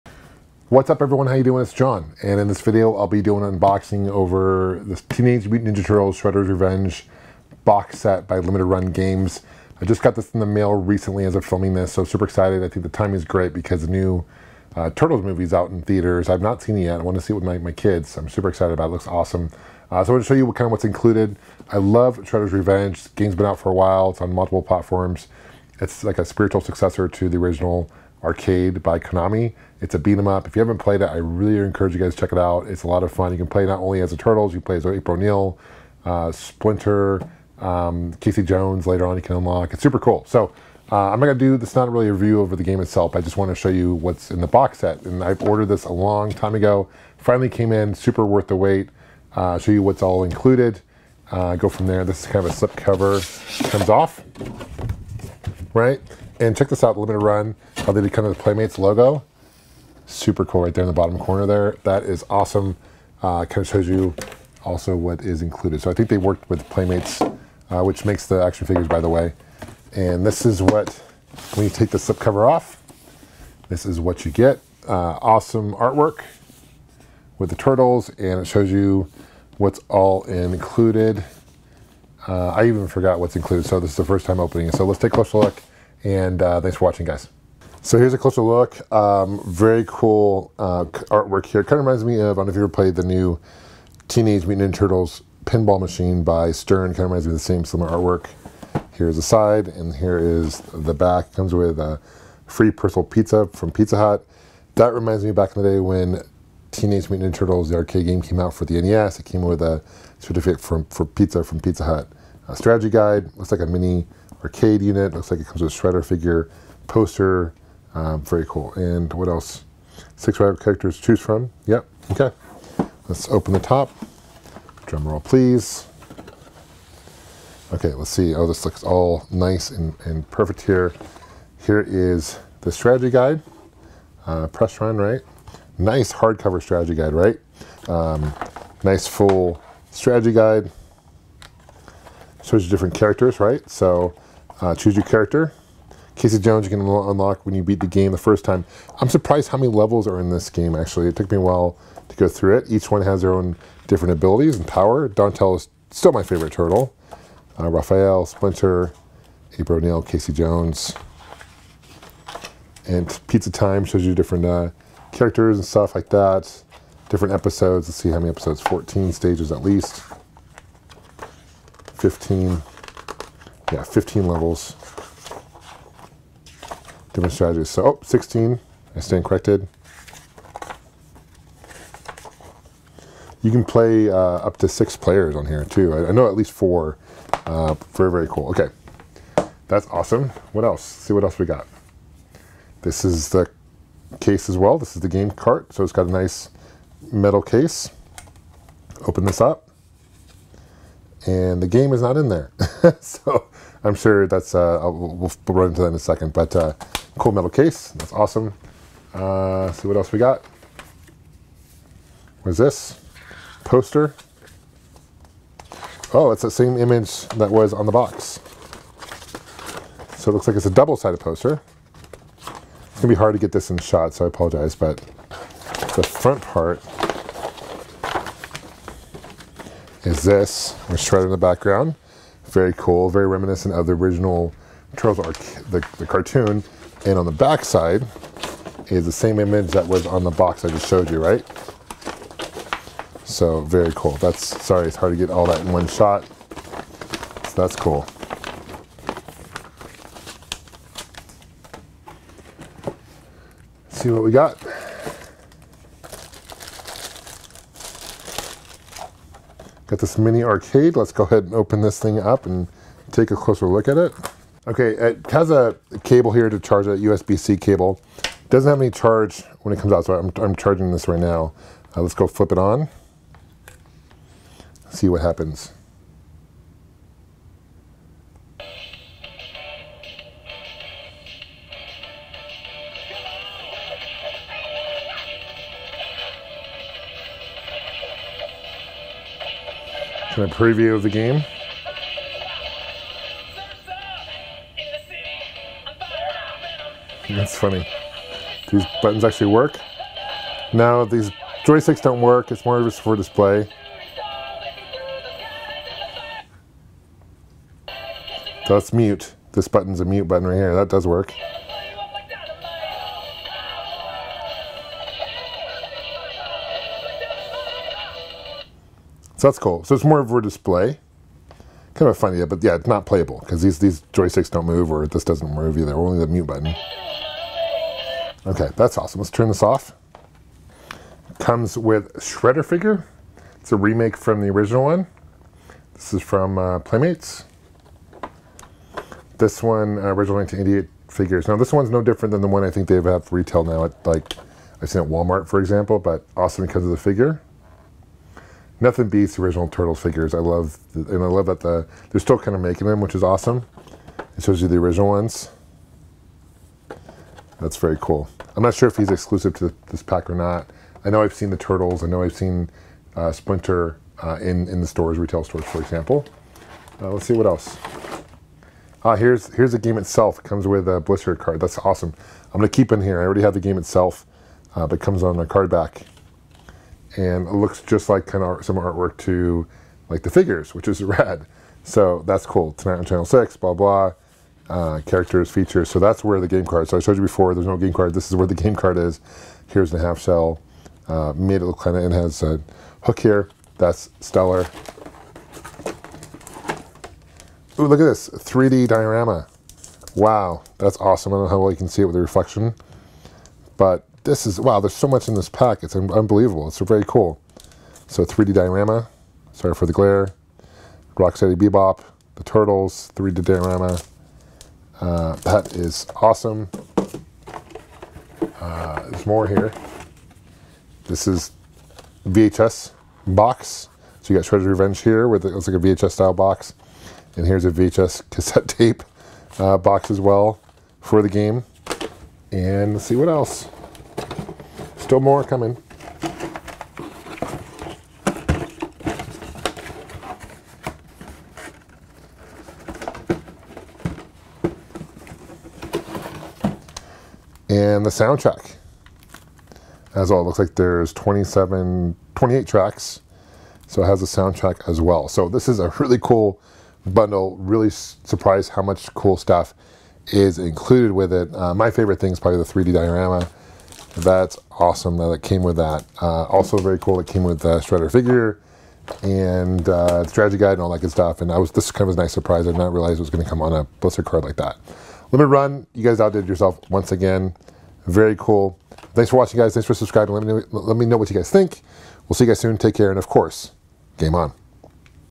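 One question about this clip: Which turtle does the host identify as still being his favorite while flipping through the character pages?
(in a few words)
Donatello.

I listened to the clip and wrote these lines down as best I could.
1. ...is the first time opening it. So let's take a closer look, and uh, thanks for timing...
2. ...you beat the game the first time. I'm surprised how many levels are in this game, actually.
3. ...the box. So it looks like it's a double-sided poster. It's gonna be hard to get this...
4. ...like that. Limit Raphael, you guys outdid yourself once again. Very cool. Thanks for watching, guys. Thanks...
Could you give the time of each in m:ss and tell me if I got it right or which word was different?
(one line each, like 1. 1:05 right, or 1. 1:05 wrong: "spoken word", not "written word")
1. 1:23 wrong: "watching", not "timing"
2. 2:27 right
3. 3:37 right
4. 7:54 wrong: "Run", not "Raphael".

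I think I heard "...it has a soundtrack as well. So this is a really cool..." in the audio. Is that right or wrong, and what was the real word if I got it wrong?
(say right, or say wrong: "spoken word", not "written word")
right.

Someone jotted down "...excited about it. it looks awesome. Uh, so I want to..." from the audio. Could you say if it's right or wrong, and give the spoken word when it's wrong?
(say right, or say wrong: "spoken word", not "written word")
right.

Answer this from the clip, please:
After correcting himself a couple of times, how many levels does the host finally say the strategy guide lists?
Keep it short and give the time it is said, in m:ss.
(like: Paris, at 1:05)
16, at 2:58.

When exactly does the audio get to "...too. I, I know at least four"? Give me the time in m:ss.
3:05.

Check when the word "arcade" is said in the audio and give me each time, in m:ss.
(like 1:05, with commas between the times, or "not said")
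0:28, 1:47, 1:54, 4:20.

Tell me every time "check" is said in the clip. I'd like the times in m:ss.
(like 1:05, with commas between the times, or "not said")
0:32, 0:56.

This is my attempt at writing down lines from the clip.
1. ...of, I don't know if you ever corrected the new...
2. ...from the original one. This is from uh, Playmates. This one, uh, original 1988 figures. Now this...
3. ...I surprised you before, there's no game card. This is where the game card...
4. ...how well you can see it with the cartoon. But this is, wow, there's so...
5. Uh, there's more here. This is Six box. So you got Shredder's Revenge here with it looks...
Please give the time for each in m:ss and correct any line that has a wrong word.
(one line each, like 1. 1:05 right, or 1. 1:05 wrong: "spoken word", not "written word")
1. 1:32 wrong: "played", not "corrected"
2. 5:34 right
3. 6:26 wrong: "showed", not "surprised"
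4. 6:41 wrong: "reflection", not "cartoon"
5. 6:58 wrong: "VHS", not "Six".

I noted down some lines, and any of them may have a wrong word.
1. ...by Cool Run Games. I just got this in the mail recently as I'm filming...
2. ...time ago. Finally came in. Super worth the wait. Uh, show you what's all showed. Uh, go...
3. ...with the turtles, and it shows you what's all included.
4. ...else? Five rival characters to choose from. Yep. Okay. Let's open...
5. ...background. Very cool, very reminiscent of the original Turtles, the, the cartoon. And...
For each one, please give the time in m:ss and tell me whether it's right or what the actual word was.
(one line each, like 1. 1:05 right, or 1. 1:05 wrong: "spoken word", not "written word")
1. 0:08 wrong: "Limited", not "Cool"
2. 0:46 wrong: "included", not "showed"
3. 1:17 right
4. 1:59 wrong: "Six", not "Five"
5. 3:51 right.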